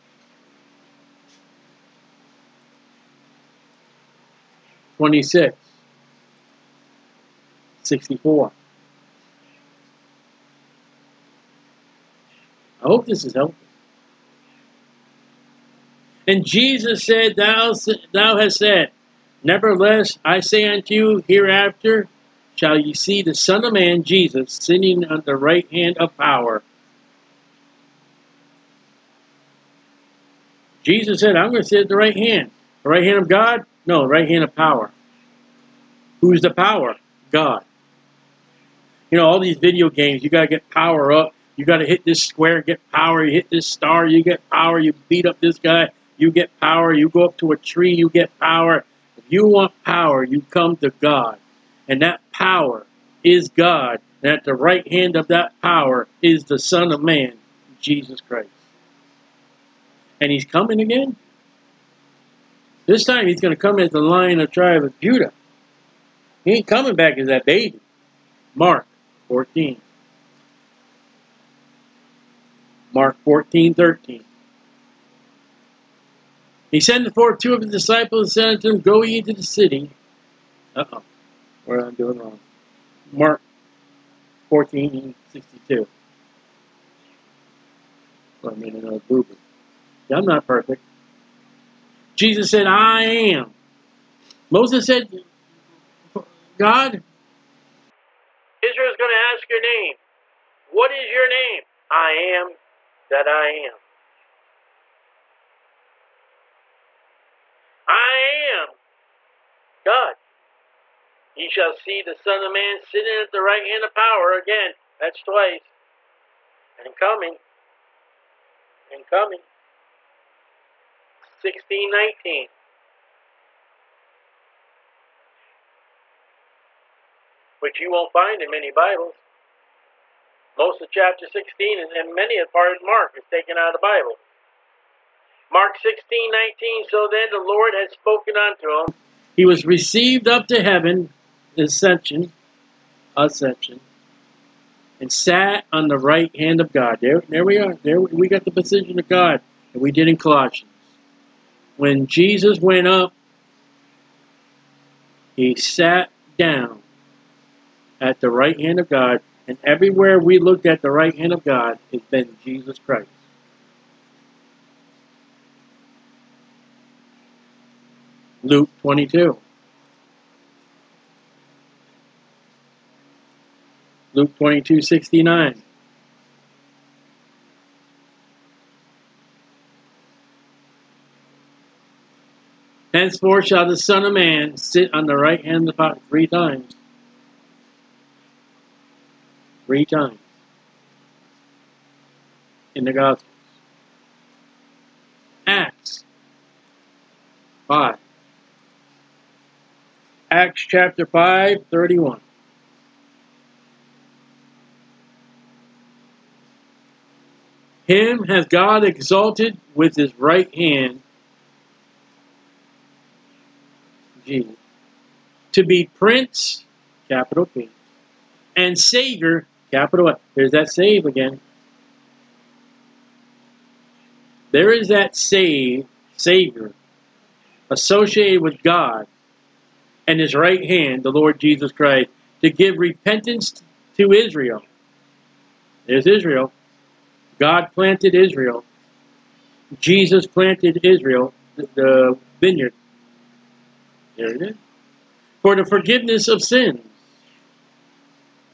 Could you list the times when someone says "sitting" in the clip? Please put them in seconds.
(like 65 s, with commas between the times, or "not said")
24 s, 112 s.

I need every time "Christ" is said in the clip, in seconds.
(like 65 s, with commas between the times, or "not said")
58 s, 162 s, 231 s.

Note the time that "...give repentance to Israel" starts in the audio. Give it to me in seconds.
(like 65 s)
232 s.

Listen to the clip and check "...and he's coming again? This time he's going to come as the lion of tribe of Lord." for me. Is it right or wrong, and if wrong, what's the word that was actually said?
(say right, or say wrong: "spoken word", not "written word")
wrong: "Judah", not "Lord".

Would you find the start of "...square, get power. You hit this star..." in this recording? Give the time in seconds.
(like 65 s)
42 s.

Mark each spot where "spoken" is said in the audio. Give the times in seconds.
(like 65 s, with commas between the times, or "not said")
137 s.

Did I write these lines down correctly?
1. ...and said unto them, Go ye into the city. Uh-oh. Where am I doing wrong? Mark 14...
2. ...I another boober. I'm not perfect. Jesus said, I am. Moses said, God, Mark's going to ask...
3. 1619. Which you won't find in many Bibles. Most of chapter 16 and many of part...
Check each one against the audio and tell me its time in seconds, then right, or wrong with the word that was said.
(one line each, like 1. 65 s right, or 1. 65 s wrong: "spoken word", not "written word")
1. 78 s right
2. 88 s wrong: "Israel", not "Mark"
3. 121 s right.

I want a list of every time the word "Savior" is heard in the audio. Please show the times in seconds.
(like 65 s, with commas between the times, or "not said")
218 s, 226 s.